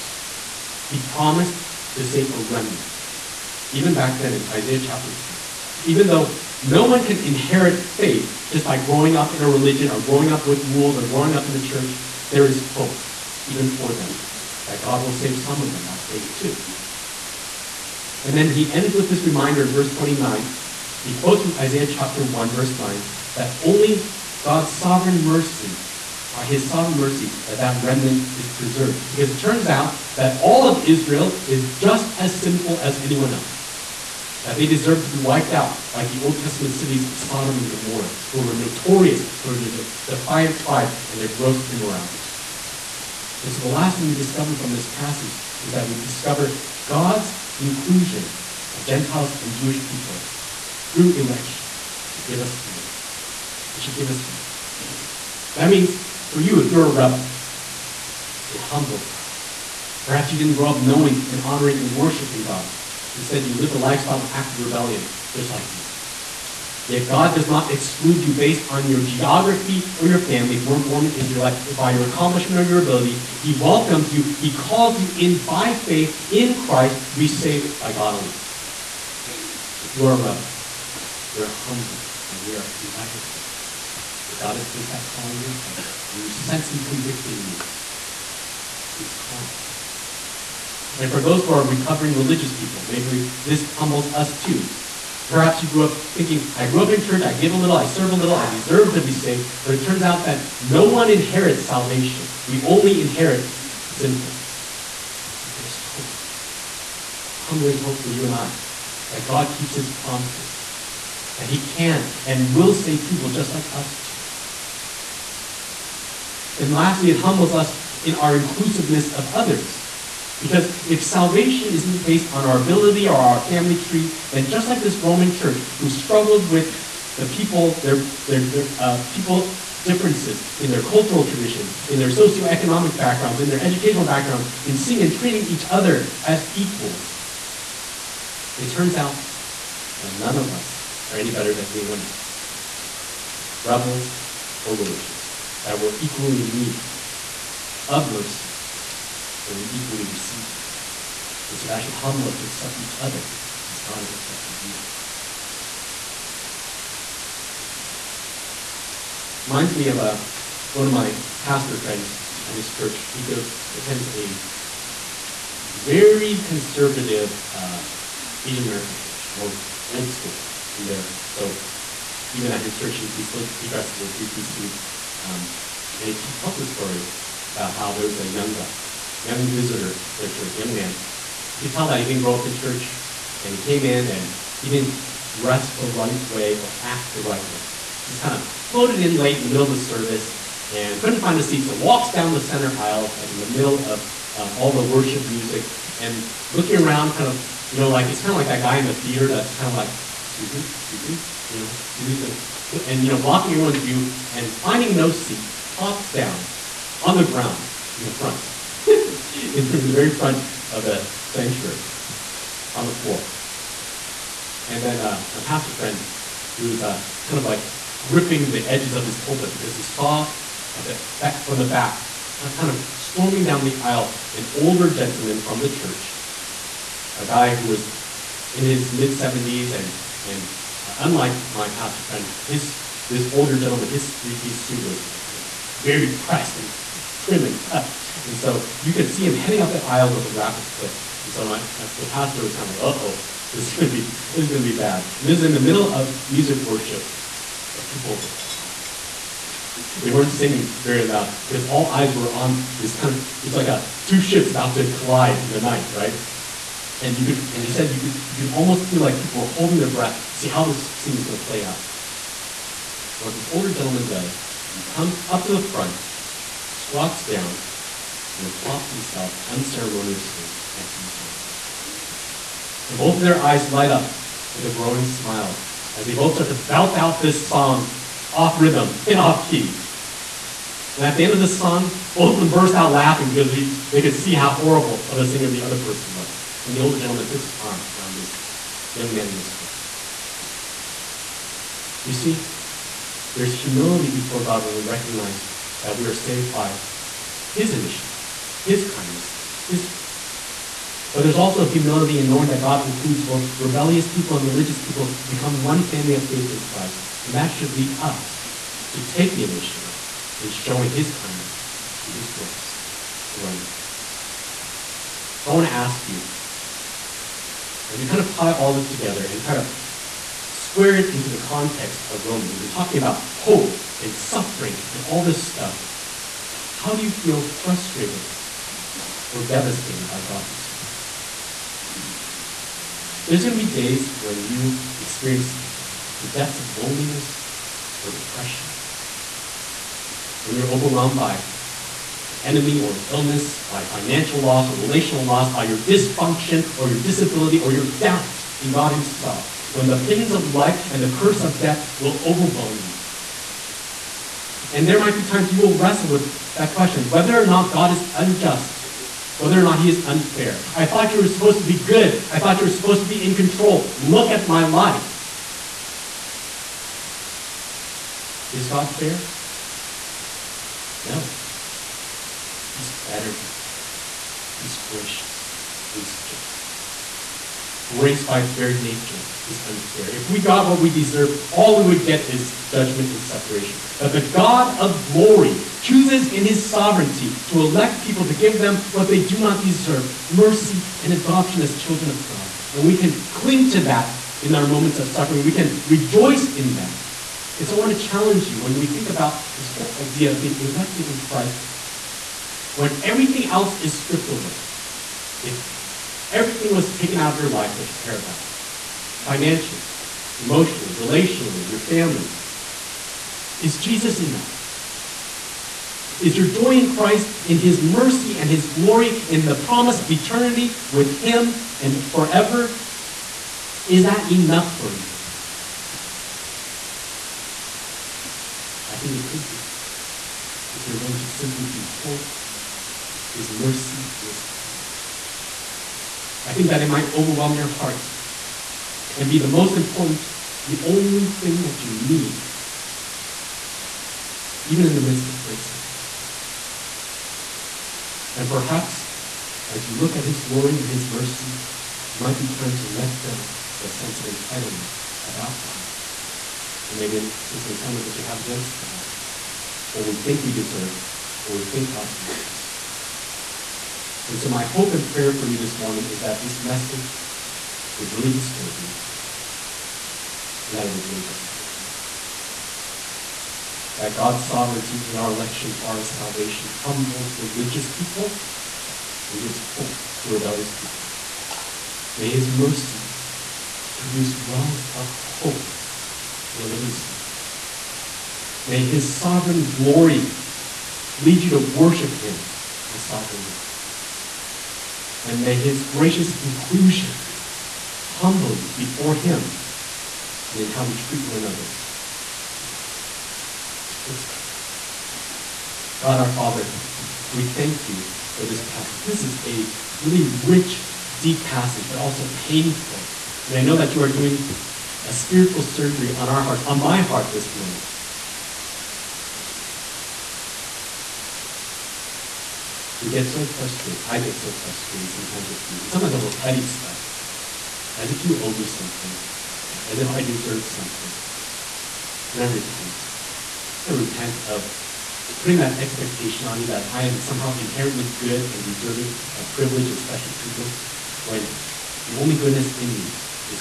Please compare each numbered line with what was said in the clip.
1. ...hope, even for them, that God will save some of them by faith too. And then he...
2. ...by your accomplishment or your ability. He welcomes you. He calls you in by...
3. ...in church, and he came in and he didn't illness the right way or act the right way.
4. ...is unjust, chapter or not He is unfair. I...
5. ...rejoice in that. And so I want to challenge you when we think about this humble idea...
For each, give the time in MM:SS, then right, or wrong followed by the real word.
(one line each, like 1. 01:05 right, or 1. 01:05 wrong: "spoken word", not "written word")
1. 00:12 right
2. 01:11 right
3. 03:02 wrong: "dress", not "illness"
4. 05:57 wrong: "whether", not "chapter"
5. 06:35 wrong: "whole", not "humble".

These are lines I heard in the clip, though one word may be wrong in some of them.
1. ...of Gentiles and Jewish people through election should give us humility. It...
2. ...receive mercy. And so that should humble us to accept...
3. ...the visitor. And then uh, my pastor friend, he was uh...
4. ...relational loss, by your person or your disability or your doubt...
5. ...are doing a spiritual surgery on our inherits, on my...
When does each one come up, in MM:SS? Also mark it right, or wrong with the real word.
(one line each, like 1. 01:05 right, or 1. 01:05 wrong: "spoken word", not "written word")
1. 00:48 right
2. 02:30 right
3. 03:32 wrong: "floor", not "visitor"
4. 05:44 wrong: "dysfunction", not "person"
5. 08:34 wrong: "hearts", not "inherits".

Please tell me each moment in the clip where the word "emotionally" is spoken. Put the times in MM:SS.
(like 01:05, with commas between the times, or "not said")
06:50.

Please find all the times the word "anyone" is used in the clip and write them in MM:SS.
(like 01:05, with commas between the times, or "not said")
00:32, 02:21.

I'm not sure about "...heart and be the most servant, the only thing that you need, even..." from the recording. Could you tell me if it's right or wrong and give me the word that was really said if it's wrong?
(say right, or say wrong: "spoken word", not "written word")
wrong: "important", not "servant".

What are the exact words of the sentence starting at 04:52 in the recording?
You see, there's humility before God when we recognize that we are saved by His initiative, His kindness, His grace.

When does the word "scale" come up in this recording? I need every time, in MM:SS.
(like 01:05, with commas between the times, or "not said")
not said.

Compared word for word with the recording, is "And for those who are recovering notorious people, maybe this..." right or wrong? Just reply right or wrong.
wrong.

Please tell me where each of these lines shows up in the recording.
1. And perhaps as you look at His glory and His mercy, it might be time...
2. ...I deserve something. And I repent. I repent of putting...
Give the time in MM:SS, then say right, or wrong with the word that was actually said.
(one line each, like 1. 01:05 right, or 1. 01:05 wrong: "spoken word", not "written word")
1. 07:28 right
2. 08:50 right.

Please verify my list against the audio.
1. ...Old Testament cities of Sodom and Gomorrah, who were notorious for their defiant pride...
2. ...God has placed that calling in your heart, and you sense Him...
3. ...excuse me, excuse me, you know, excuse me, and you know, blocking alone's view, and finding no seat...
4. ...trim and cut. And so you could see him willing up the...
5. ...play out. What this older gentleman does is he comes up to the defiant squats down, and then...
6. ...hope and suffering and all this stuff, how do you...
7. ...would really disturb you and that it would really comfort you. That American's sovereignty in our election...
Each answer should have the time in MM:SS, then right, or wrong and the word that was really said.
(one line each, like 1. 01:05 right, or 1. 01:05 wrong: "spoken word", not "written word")
1. 00:36 right
2. 01:24 right
3. 03:20 wrong: "everyone", not "alone"
4. 03:57 wrong: "heading", not "willing"
5. 04:21 wrong: "front", not "defiant"
6. 05:23 right
7. 07:47 wrong: "God", not "American".